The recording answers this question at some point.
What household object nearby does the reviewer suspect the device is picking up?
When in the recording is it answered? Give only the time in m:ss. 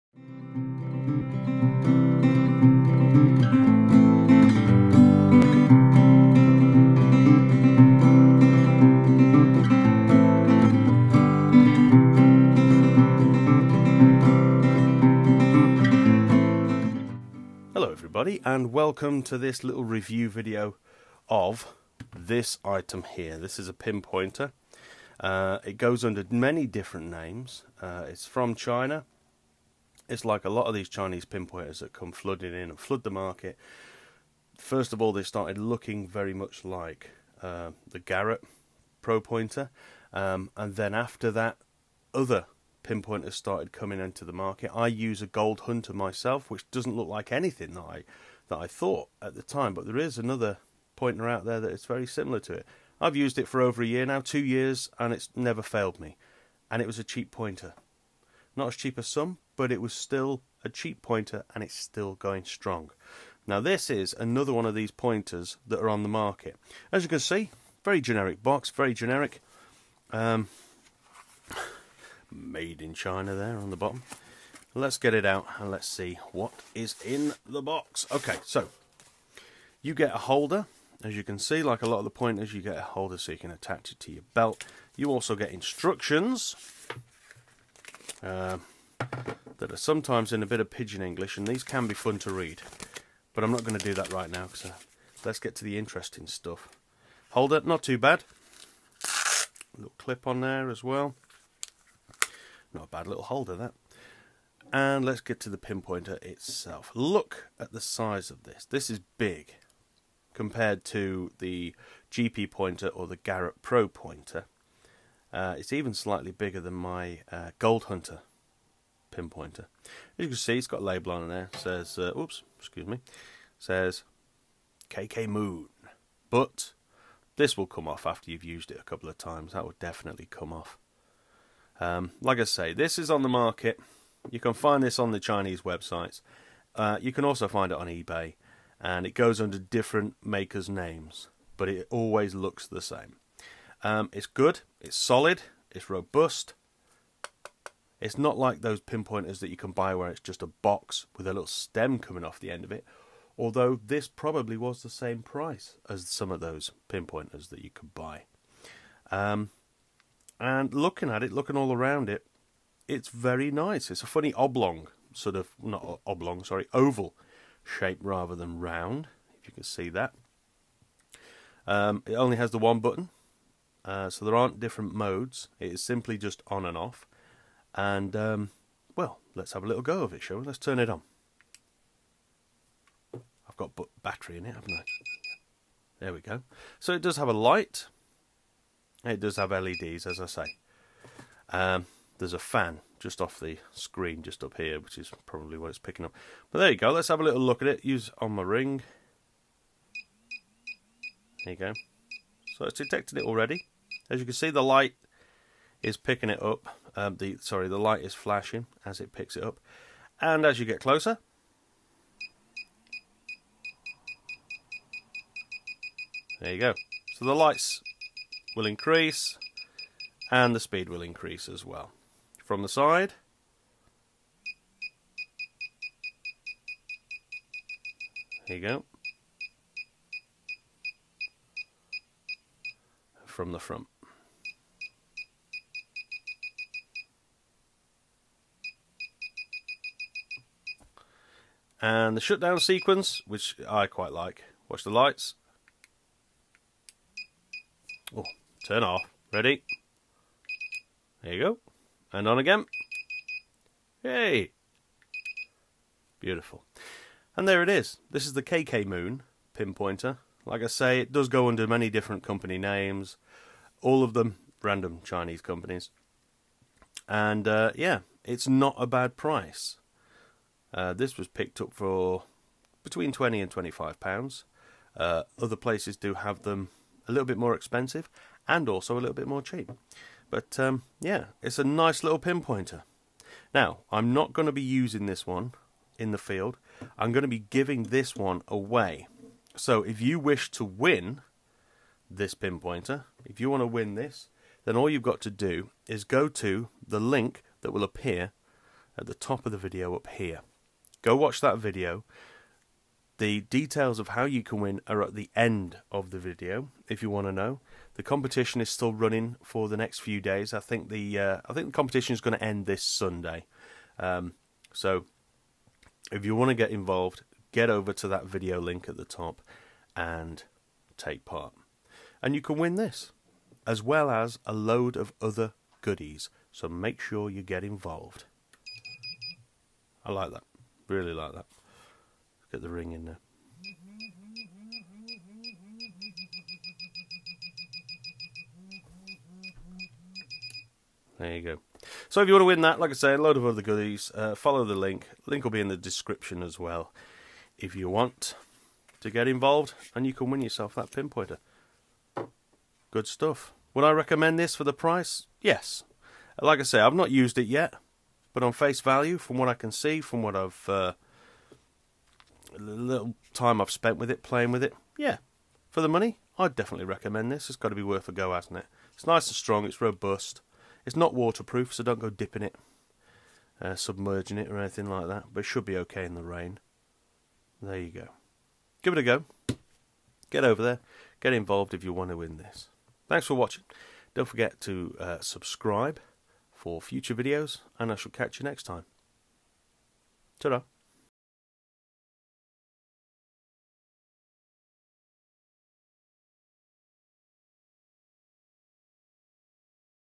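3:12.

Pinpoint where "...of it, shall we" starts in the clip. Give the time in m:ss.
3:00.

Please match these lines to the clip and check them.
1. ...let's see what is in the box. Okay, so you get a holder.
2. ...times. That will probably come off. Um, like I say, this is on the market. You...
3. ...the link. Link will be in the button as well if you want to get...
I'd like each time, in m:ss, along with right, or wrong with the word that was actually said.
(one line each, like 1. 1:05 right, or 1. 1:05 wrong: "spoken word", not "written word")
1. 1:15 right
2. 2:09 wrong: "definitely", not "probably"
3. 5:44 wrong: "description", not "button".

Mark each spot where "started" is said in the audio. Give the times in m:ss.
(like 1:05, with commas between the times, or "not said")
0:35, 0:43.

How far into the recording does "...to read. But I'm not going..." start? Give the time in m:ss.
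1:32.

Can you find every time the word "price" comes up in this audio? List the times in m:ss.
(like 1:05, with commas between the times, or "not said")
2:35, 4:29, 5:54.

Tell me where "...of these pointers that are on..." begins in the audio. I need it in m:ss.
1:04.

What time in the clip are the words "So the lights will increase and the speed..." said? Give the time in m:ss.
3:37.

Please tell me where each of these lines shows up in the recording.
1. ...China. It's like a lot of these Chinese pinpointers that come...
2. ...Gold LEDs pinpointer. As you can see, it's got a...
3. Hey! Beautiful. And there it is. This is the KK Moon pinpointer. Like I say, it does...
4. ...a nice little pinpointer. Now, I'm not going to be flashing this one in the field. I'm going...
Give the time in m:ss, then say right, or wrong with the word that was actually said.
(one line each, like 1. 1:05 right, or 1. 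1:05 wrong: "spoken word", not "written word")
1. 0:28 right
2. 1:57 wrong: "Hunter", not "LEDs"
3. 4:14 right
4. 4:41 wrong: "using", not "flashing".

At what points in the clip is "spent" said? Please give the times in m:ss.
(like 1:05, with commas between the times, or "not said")
6:03.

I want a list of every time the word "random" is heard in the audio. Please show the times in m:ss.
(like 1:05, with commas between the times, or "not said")
4:24.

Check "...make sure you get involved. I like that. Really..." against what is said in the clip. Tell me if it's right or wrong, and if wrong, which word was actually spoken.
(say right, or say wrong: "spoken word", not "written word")
right.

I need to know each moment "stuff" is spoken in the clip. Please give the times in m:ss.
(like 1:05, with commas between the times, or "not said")
1:36, 5:53.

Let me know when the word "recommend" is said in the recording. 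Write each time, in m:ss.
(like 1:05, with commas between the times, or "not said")
5:53, 6:06.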